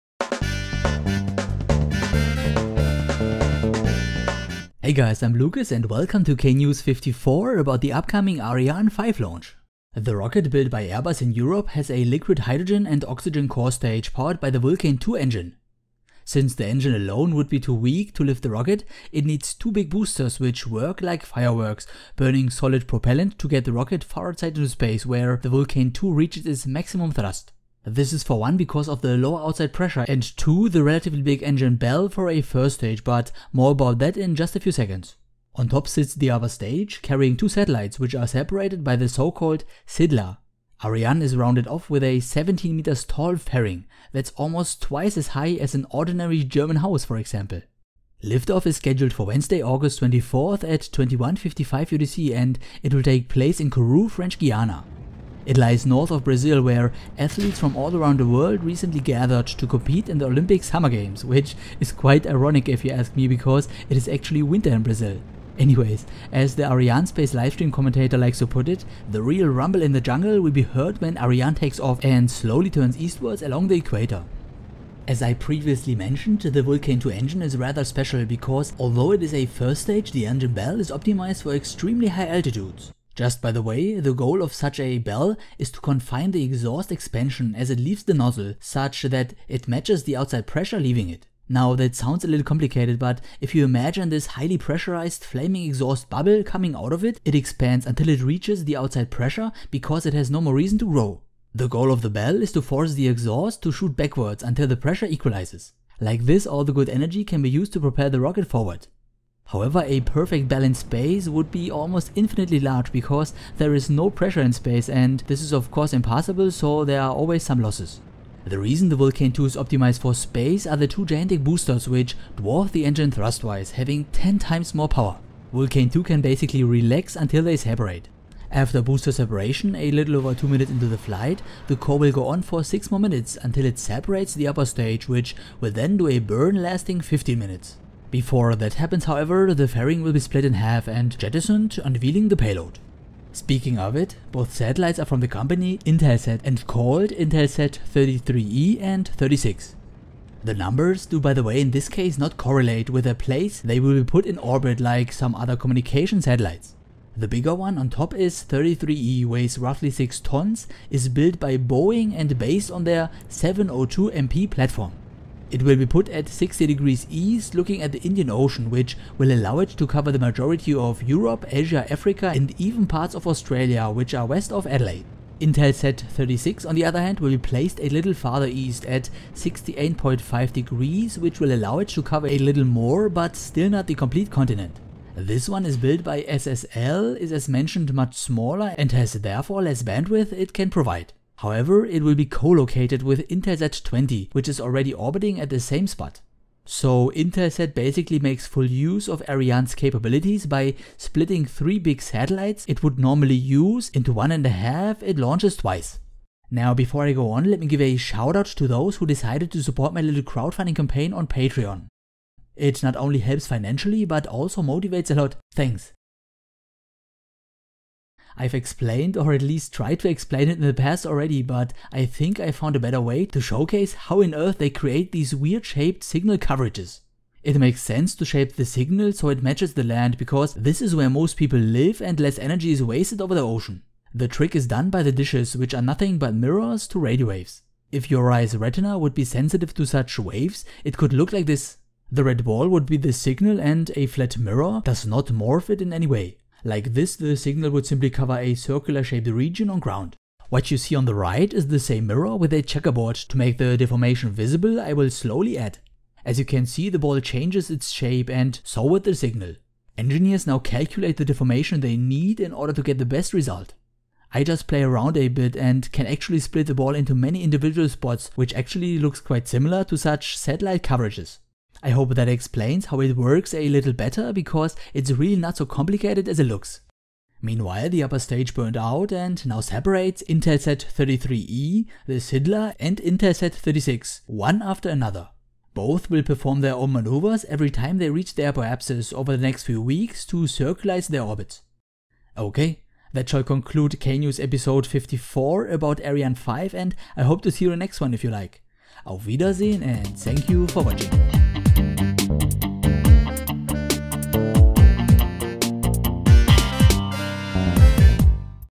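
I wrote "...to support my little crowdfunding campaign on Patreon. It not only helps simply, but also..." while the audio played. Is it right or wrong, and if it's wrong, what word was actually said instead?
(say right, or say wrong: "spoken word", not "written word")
wrong: "financially", not "simply".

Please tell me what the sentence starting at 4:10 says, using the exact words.
What you see on the right is the same mirror with a checkerboard.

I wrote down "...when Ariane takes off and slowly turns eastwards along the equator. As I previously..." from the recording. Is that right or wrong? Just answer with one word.
right.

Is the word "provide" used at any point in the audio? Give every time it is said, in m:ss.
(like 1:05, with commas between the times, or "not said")
3:10.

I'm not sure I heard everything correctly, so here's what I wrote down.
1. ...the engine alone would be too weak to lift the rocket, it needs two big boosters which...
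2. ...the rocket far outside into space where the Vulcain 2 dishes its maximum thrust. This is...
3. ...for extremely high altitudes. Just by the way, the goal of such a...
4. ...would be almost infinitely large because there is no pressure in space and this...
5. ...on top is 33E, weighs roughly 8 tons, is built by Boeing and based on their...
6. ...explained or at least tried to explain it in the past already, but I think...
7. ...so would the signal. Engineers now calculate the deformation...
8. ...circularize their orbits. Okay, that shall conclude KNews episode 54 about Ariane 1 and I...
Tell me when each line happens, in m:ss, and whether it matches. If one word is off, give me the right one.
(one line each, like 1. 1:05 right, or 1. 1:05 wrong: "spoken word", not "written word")
1. 0:16 right
2. 0:23 wrong: "reaches", not "dishes"
3. 1:21 right
4. 1:51 right
5. 2:37 wrong: "6", not "8"
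6. 3:38 right
7. 4:18 right
8. 4:50 wrong: "5", not "1".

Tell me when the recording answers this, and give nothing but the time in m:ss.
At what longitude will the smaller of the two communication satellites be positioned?
2:59.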